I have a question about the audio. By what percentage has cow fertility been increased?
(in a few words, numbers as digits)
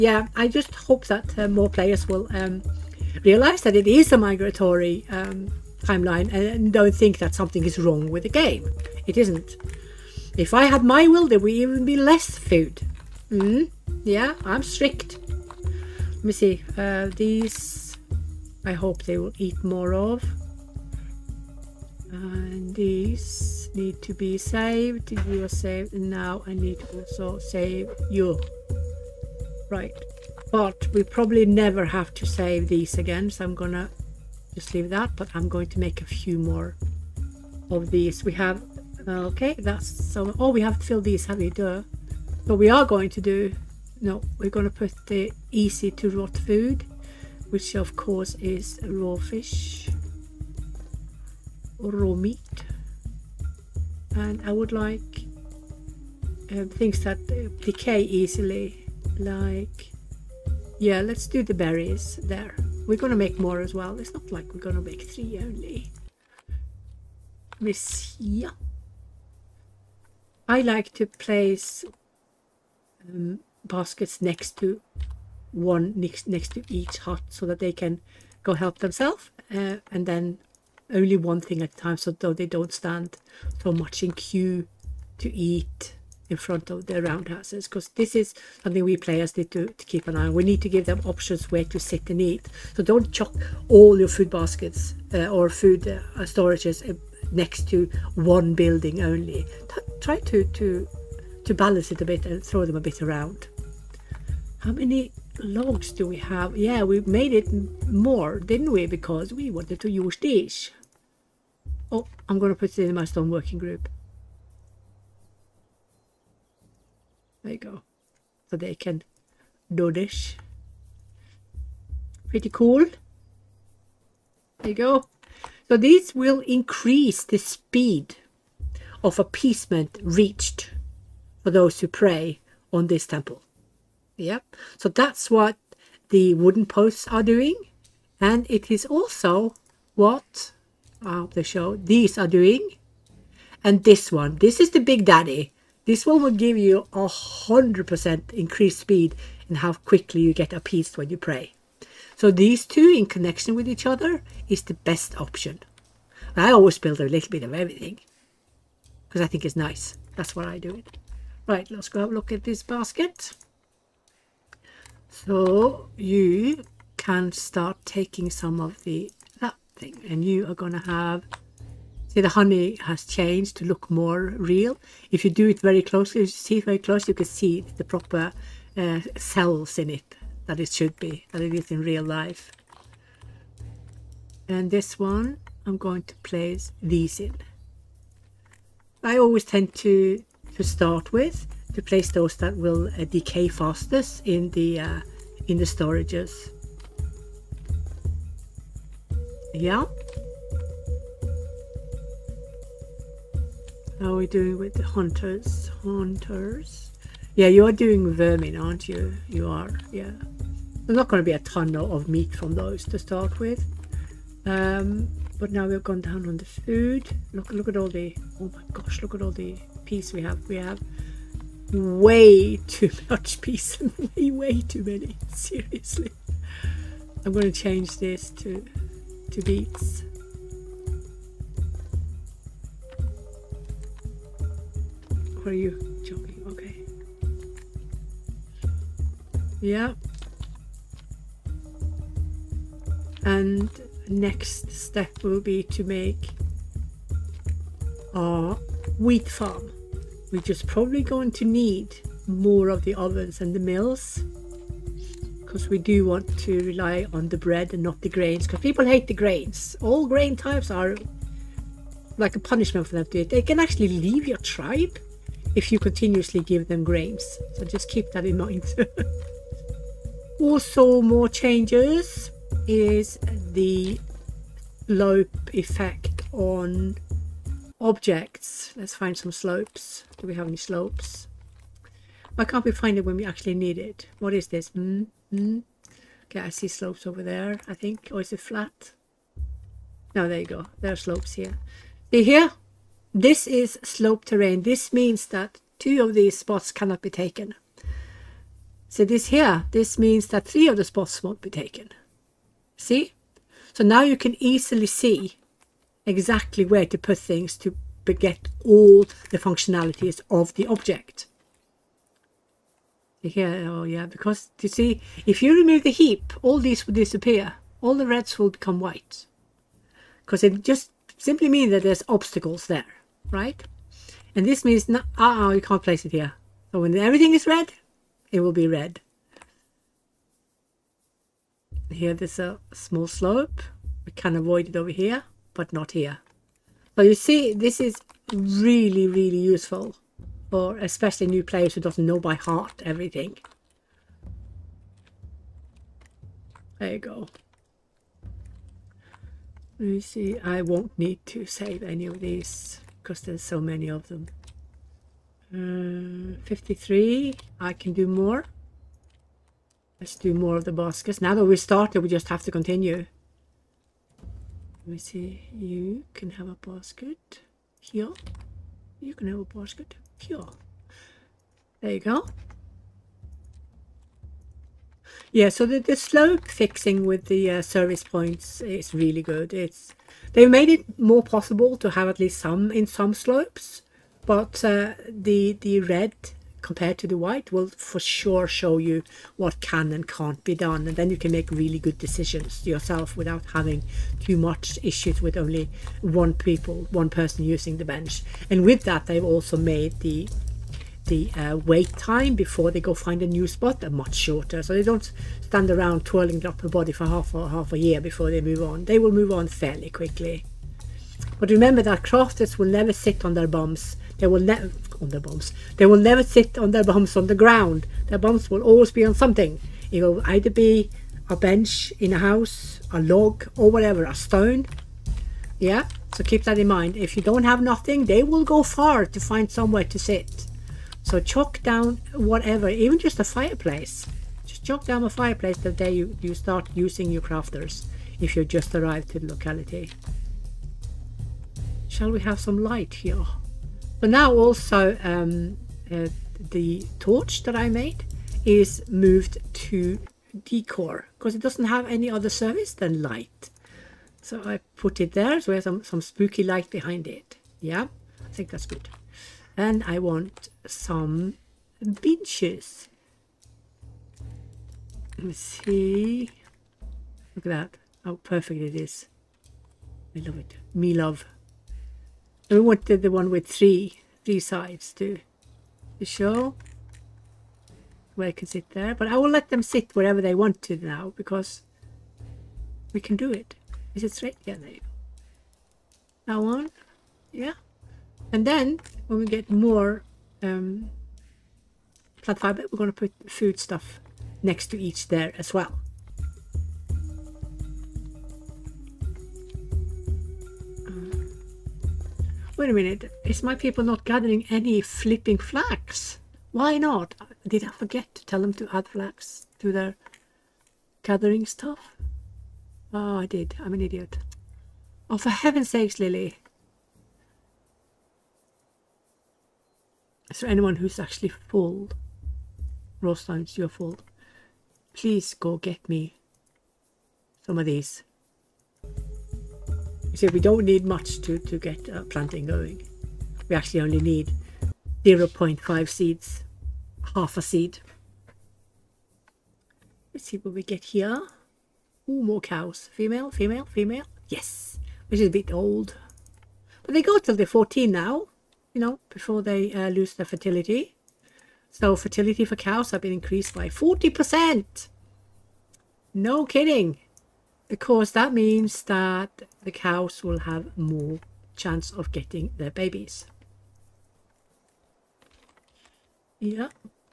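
40%.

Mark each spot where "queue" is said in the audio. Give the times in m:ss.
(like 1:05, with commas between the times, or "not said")
1:24.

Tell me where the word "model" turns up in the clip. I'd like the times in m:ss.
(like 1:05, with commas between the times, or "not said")
not said.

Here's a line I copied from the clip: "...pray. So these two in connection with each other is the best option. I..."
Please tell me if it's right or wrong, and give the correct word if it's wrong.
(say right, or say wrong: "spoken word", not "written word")
right.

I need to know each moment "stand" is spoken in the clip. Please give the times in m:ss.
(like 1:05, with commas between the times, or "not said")
1:22, 6:45.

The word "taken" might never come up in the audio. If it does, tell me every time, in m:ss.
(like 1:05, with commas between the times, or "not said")
4:57, 5:01.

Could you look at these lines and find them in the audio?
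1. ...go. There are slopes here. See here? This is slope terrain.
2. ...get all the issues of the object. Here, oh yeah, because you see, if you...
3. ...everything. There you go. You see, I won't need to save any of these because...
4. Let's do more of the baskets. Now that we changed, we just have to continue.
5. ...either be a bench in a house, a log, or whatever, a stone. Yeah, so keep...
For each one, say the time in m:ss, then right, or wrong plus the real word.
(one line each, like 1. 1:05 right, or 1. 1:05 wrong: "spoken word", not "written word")
1. 4:50 right
2. 5:08 wrong: "functionalities", not "issues"
3. 5:42 right
4. 6:00 wrong: "started", not "changed"
5. 7:00 right.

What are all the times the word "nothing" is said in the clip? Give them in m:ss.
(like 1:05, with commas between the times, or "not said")
7:07.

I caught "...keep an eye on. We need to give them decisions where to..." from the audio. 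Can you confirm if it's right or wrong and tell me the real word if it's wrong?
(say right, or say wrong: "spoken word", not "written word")
wrong: "options", not "decisions".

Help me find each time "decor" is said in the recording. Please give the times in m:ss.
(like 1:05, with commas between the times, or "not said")
7:30.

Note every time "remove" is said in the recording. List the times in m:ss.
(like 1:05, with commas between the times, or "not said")
5:15.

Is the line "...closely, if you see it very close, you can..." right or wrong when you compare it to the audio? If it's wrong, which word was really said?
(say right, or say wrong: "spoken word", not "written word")
right.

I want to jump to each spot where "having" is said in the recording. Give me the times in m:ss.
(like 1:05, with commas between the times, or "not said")
6:33.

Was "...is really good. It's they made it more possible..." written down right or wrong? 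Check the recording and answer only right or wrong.
right.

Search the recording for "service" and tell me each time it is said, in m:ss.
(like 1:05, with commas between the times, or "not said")
6:17, 7:32.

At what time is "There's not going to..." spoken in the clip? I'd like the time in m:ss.
3:30.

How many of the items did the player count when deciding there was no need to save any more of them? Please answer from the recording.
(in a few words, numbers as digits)
53.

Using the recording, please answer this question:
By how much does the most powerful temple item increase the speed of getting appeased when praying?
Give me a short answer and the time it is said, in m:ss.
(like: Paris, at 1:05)
100%, at 2:27.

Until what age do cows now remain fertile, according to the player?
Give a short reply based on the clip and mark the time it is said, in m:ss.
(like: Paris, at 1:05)
14, at 9:07.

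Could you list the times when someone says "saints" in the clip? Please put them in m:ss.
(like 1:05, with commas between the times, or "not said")
not said.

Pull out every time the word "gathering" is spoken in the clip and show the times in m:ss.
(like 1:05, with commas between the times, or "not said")
8:24, 8:31.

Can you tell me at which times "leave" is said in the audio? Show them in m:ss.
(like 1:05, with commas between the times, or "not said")
0:34, 4:23.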